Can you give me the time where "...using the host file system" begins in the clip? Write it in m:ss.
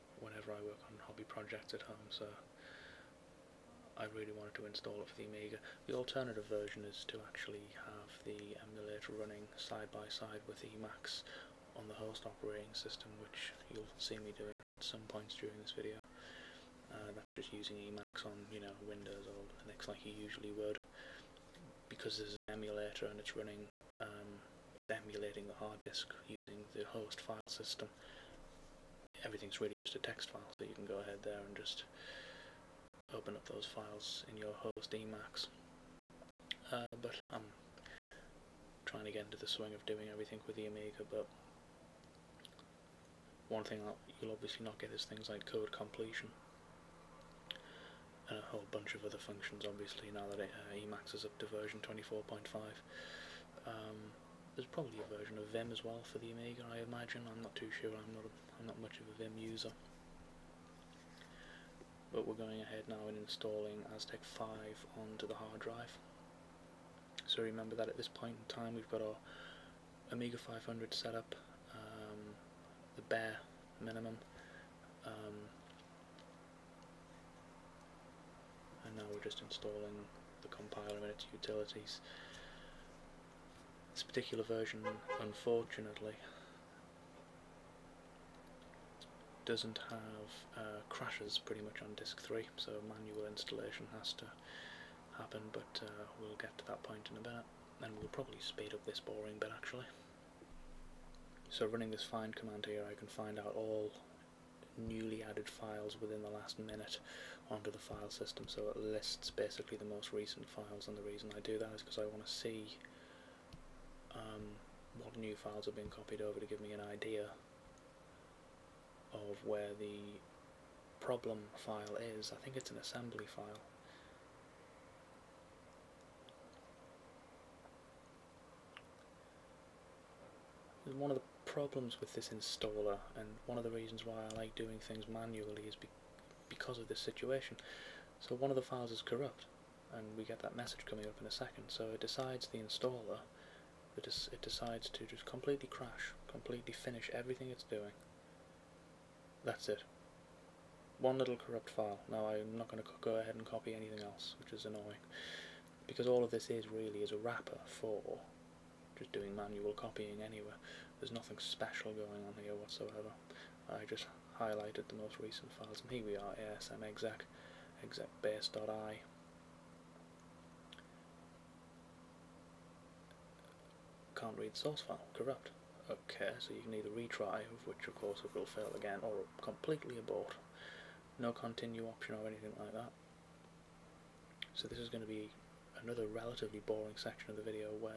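0:26.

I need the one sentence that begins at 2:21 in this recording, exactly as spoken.
So it decides the installer, it, it decides to just completely crash, completely finish everything it's doing.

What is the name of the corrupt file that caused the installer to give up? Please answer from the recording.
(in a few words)
execbase.i.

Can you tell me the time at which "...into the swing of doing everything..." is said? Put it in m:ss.
0:39.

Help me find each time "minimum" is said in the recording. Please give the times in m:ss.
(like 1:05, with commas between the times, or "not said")
1:13.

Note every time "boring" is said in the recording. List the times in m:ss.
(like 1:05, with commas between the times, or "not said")
1:38, 3:06.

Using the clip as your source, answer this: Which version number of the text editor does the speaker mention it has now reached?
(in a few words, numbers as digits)
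24.5.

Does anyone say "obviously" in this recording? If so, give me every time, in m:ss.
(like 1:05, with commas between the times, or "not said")
0:44, 0:49.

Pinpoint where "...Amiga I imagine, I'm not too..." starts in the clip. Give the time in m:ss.
0:56.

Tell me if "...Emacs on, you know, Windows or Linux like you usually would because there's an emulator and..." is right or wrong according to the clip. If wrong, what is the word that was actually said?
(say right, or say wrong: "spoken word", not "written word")
right.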